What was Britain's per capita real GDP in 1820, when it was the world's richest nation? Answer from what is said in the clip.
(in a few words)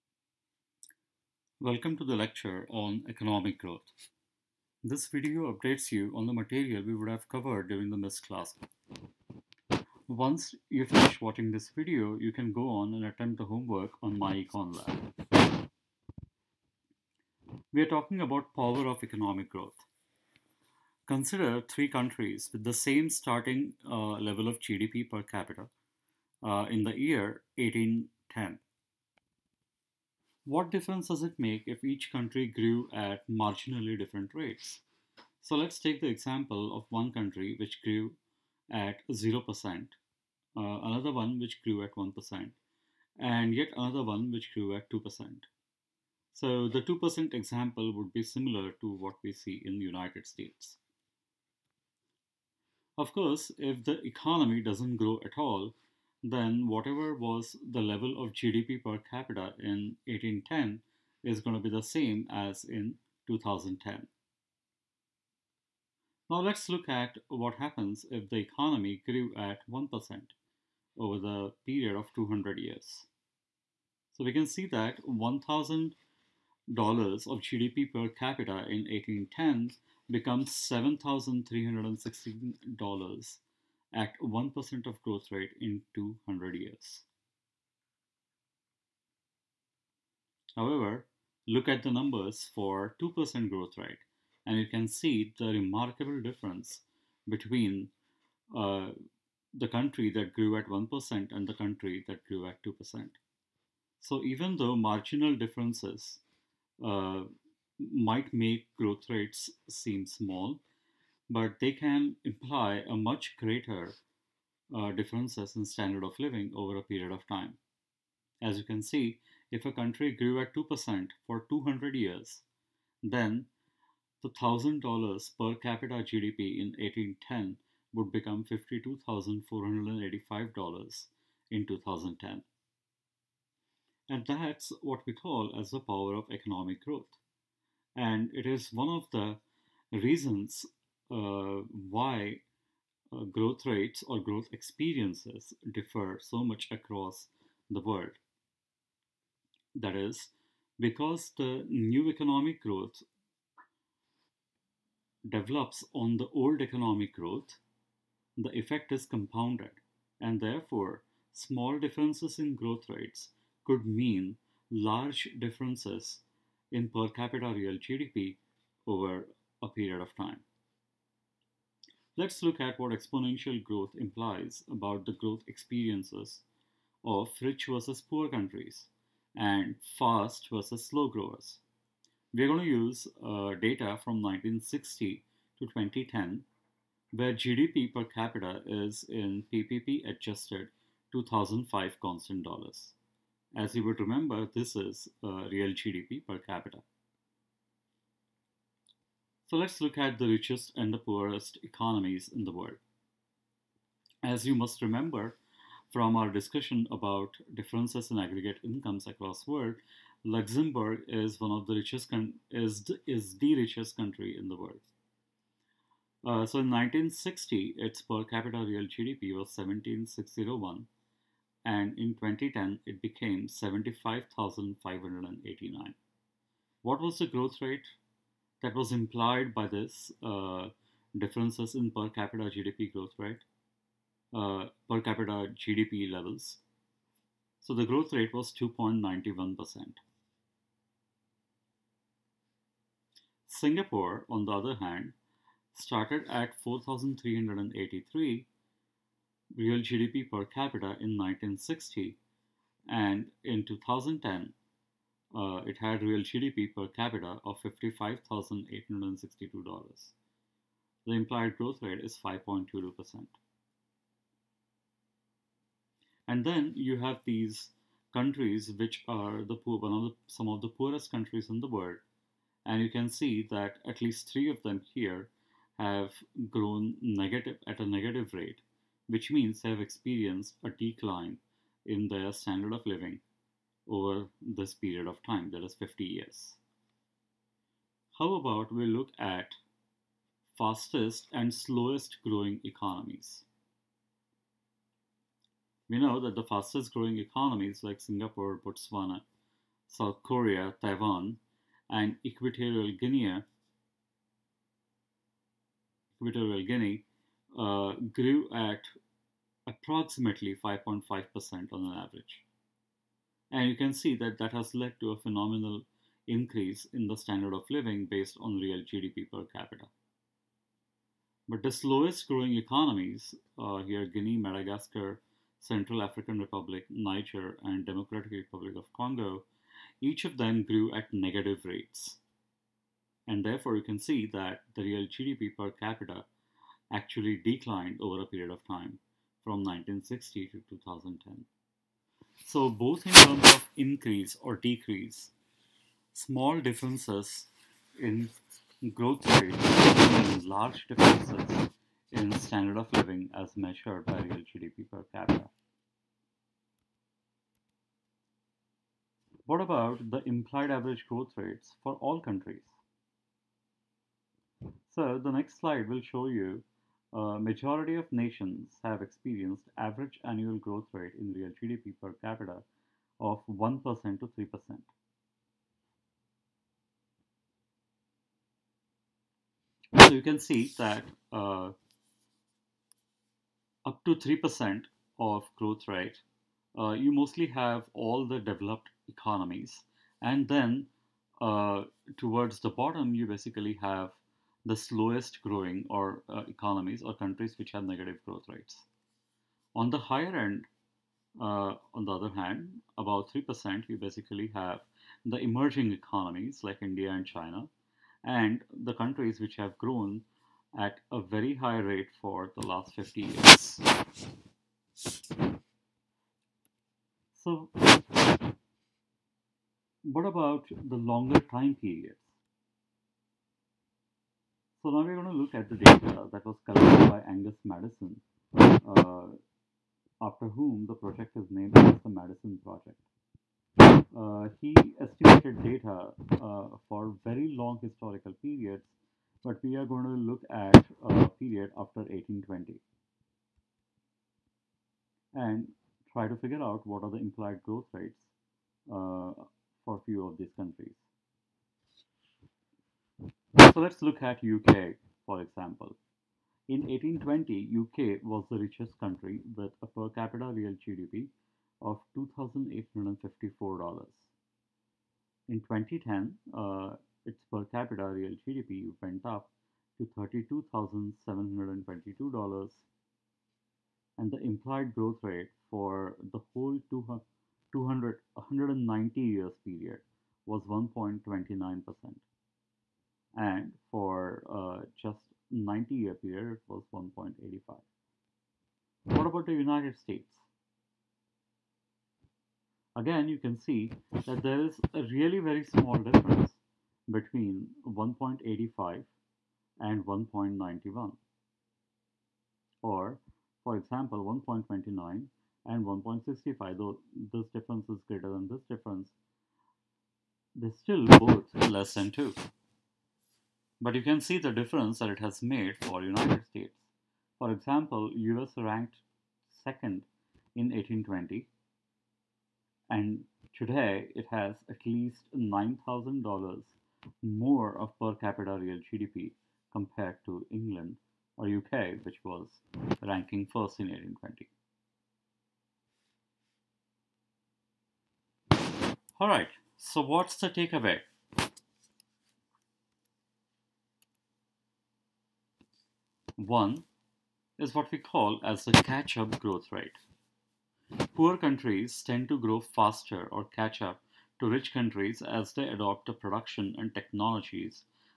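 $2,854.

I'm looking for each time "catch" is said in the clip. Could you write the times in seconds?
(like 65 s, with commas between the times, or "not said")
548 s, 553 s.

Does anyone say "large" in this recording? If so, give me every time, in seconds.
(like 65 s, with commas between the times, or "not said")
164 s, 350 s.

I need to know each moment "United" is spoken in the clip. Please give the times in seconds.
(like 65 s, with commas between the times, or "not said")
49 s, 489 s, 516 s.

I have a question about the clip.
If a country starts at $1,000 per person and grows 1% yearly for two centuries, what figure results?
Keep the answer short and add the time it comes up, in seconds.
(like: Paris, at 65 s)
$7,316, at 80 s.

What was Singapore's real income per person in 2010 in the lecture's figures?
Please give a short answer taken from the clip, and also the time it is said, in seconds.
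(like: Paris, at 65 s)
$55,862, at 257 s.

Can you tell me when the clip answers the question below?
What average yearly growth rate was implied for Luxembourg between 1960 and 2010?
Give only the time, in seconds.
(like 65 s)
238 s.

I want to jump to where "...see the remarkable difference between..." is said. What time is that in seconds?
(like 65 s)
94 s.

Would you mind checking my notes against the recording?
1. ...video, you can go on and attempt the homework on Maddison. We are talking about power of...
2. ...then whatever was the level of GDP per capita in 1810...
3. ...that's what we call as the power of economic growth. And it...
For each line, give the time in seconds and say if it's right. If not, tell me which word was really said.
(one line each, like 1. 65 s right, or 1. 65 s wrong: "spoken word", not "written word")
1. 11 s wrong: "MyEconLab", not "Maddison"
2. 56 s right
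3. 134 s right.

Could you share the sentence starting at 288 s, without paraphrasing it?
How about we look at fastest and slowest growing economies?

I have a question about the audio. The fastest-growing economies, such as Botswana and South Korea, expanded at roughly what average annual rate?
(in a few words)
5.5%.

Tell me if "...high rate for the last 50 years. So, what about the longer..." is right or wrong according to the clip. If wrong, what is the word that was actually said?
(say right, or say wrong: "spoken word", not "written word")
right.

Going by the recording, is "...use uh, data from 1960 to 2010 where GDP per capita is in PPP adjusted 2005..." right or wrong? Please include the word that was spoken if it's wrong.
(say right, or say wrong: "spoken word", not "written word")
right.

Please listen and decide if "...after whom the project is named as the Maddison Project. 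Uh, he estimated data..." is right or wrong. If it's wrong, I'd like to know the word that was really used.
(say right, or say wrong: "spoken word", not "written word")
right.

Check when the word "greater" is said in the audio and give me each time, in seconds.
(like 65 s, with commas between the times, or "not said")
113 s, 508 s.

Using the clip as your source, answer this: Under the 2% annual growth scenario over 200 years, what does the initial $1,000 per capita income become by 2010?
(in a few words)
$52,485.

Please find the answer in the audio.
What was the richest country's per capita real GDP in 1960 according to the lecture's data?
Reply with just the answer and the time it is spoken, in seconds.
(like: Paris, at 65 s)
17,601, at 219 s.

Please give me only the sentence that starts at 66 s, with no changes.
Now let's look at what happens if the economy grew at 1% over the period of 200 years.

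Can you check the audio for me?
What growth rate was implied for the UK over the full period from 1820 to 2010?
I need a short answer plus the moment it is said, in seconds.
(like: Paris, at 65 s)
1.29%, at 480 s.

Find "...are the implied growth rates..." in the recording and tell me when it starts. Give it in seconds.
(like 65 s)
447 s.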